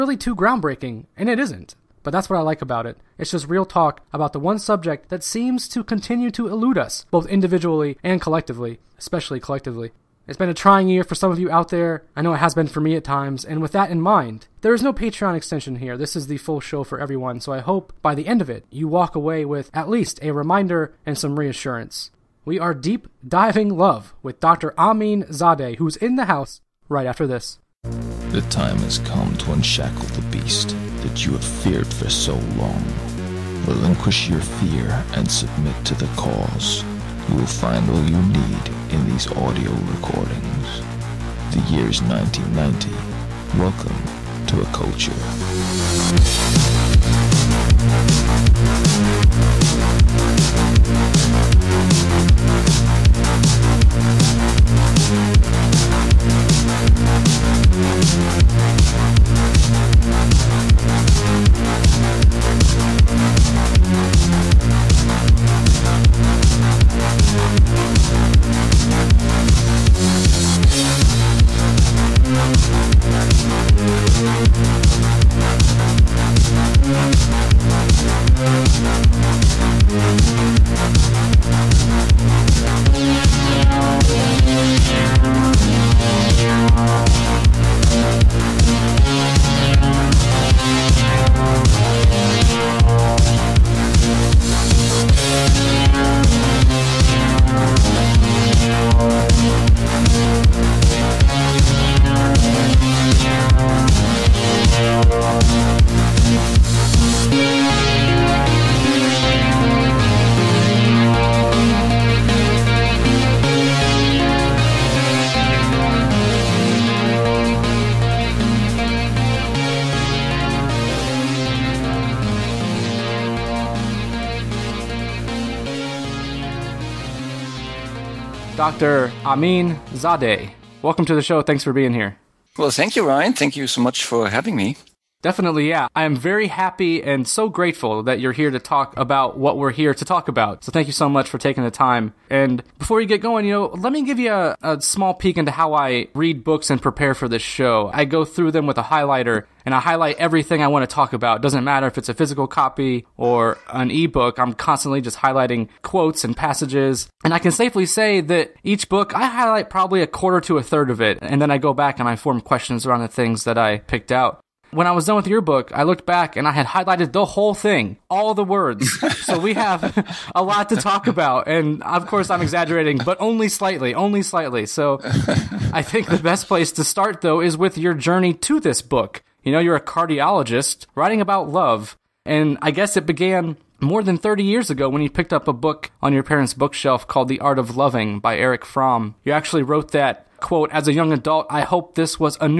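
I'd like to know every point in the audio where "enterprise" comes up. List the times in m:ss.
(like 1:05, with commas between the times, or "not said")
not said.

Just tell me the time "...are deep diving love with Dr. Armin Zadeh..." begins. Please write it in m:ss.
0:22.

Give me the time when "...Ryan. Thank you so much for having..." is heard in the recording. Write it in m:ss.
2:13.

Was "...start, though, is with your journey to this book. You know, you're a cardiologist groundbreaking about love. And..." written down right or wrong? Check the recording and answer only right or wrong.
wrong.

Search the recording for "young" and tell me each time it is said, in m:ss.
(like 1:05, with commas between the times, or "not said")
3:10.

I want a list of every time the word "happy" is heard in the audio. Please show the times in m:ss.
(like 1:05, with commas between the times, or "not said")
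2:16.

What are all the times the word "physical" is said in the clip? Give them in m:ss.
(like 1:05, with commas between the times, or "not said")
2:32.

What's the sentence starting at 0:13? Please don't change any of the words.
And with that in mind, there is no Patreon extension here.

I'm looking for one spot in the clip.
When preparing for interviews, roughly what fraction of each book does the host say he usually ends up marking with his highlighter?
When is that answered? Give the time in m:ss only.
2:40.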